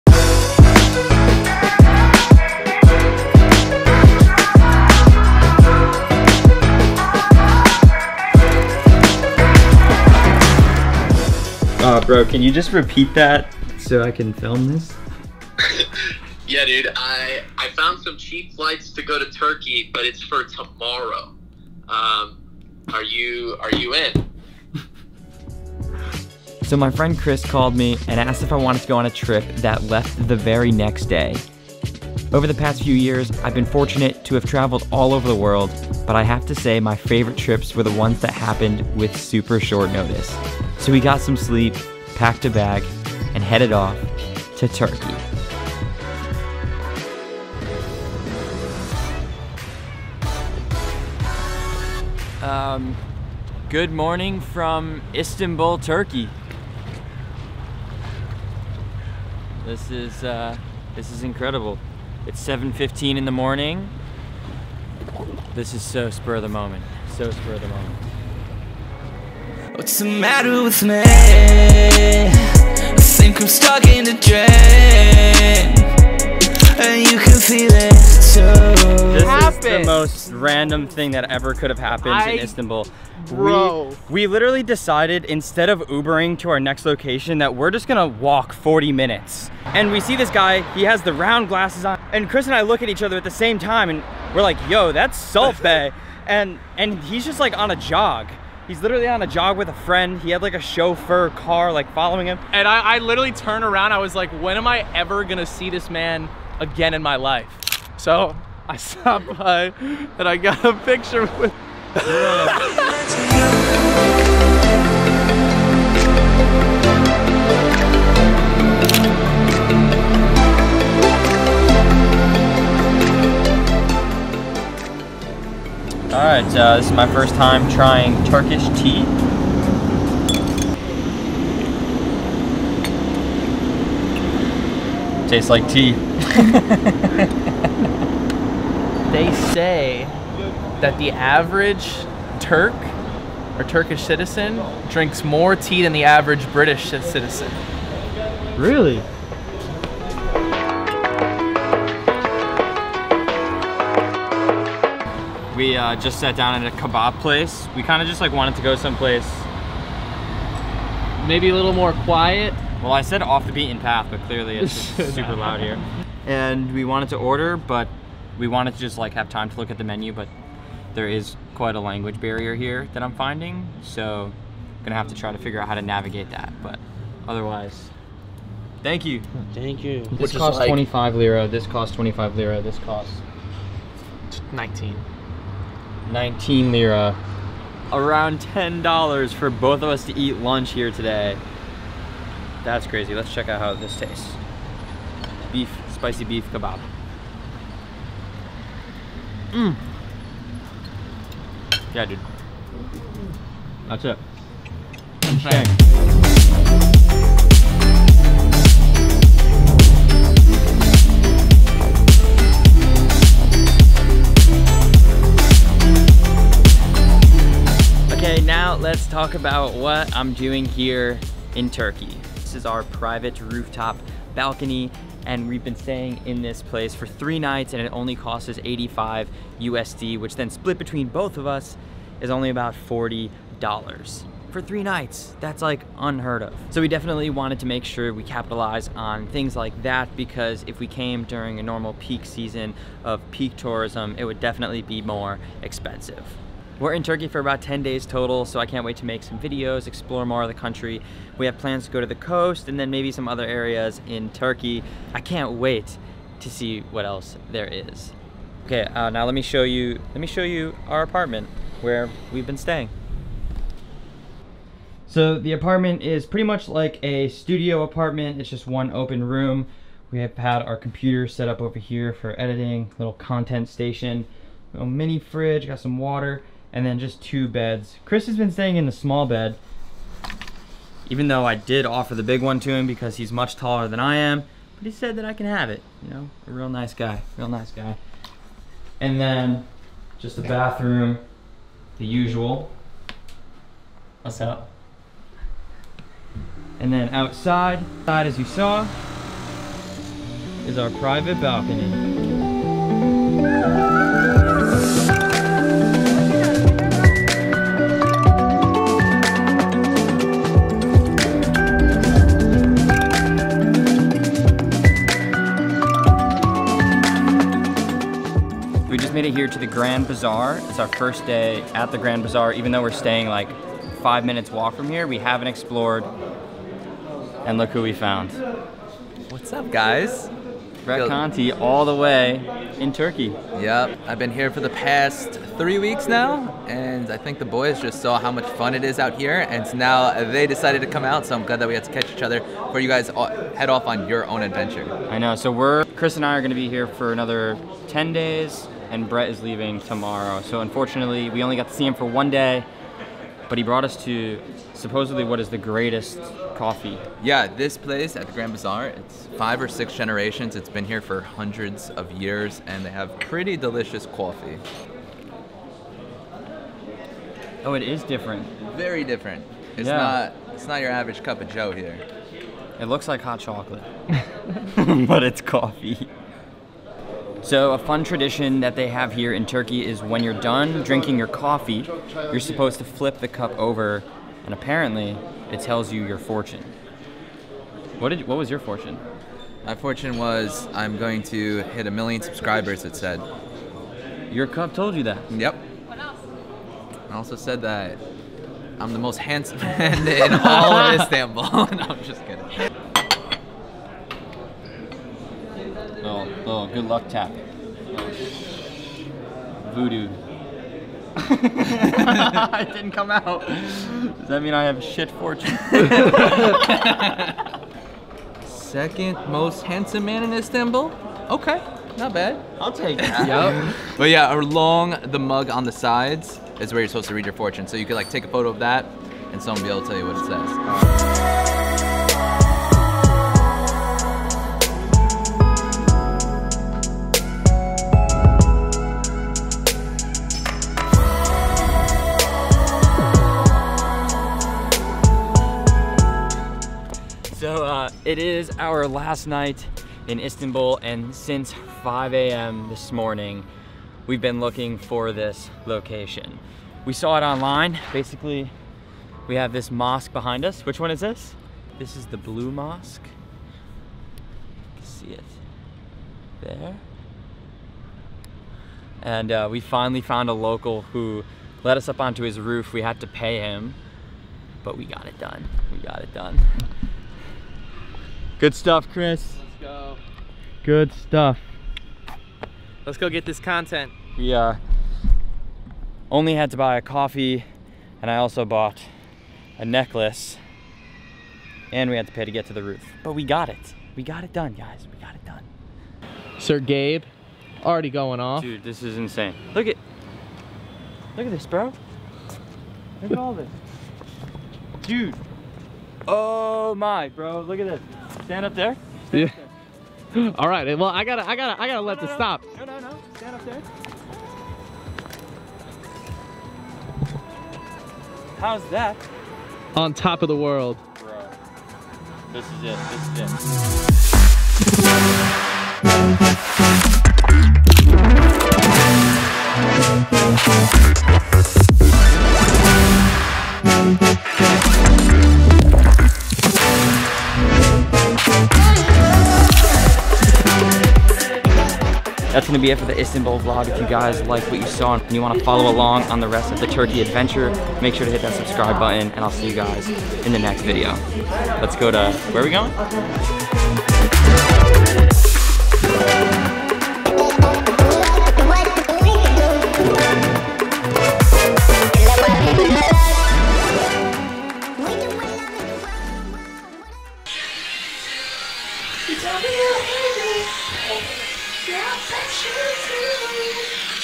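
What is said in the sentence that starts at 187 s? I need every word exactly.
Uh, Around $10 for both of us to eat lunch here today.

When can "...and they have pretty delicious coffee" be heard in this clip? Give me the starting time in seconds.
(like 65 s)
362 s.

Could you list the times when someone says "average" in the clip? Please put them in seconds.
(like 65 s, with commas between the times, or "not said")
141 s, 146 s, 370 s.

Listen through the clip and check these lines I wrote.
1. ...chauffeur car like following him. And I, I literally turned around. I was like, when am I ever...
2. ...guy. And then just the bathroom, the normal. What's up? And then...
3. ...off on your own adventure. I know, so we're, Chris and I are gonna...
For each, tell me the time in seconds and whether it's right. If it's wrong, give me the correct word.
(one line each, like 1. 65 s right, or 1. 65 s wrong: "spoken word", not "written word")
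1. 100 s right
2. 287 s wrong: "usual", not "normal"
3. 343 s right.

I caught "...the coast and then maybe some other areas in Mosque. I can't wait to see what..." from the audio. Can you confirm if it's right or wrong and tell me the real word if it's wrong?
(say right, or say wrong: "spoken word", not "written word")
wrong: "Turkey", not "Mosque".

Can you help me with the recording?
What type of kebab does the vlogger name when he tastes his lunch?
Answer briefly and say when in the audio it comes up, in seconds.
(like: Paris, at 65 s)
Spicy beef kebab, at 195 s.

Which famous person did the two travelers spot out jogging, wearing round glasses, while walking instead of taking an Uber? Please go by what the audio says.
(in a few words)
Salt Bae.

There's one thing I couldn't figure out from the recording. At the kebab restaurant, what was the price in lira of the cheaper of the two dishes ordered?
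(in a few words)
19 lira.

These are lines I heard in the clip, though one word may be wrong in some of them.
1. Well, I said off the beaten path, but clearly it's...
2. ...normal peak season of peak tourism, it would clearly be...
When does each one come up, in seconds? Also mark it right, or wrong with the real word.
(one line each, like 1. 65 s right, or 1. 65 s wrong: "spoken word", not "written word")
1. 162 s right
2. 241 s wrong: "definitely", not "clearly".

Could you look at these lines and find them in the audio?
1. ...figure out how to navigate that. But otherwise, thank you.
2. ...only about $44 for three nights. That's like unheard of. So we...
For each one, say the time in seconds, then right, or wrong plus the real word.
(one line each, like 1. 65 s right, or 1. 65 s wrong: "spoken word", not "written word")
1. 175 s right
2. 232 s wrong: "40", not "44".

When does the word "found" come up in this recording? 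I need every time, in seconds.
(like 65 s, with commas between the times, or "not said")
17 s, 327 s, 470 s.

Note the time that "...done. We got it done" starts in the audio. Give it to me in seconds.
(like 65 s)
475 s.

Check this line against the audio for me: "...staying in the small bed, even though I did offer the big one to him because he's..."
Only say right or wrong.
right.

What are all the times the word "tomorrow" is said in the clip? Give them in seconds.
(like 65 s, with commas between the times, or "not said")
20 s, 349 s.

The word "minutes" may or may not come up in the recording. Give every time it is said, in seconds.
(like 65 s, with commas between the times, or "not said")
88 s, 324 s.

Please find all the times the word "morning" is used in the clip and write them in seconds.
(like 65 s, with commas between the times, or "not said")
53 s, 63 s, 452 s.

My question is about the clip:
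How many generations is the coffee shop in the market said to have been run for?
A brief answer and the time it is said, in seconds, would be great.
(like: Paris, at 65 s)
Five or six, at 359 s.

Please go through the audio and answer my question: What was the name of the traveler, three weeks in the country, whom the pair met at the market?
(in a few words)
Brett Conti.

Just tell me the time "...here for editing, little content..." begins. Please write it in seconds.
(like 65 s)
271 s.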